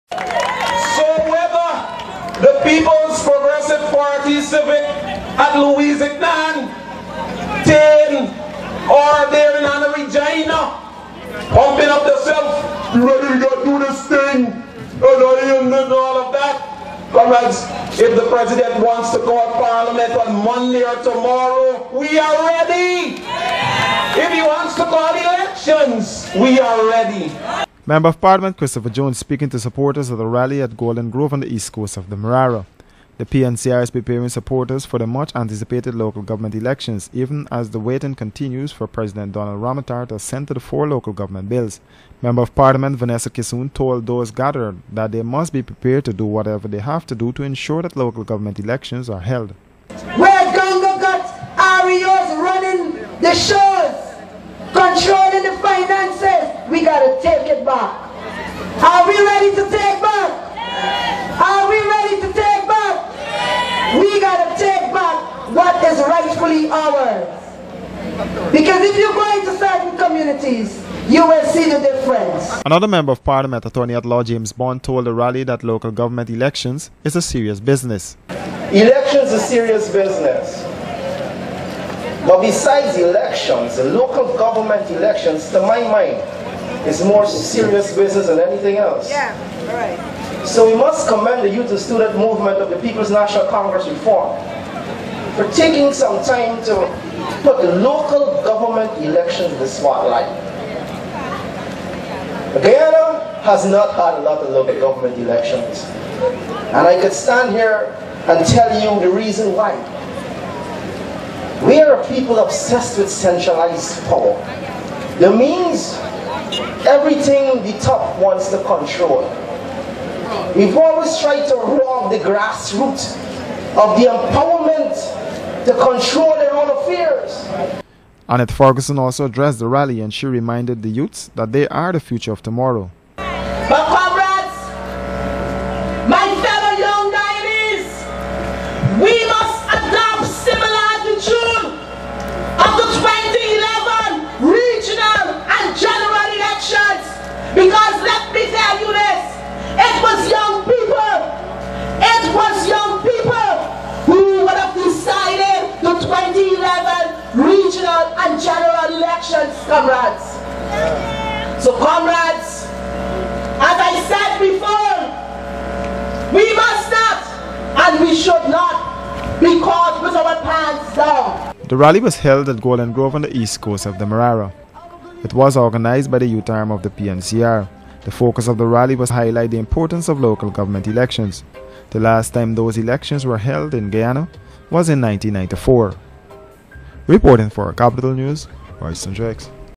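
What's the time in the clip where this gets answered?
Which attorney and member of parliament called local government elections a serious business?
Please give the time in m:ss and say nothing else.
1:14.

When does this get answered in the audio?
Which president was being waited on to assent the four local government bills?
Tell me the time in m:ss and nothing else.
0:39.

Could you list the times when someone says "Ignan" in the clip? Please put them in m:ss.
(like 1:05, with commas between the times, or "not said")
0:05.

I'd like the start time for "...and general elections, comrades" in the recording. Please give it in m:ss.
2:38.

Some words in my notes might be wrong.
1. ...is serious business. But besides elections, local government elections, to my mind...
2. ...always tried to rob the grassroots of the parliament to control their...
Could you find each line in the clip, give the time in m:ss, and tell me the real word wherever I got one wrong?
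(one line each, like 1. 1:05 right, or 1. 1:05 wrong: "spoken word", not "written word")
1. 1:19 right
2. 2:00 wrong: "empowerment", not "parliament".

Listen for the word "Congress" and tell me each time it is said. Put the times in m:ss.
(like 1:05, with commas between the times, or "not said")
1:33.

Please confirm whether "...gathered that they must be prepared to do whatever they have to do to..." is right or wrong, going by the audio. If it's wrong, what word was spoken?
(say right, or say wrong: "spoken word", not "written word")
right.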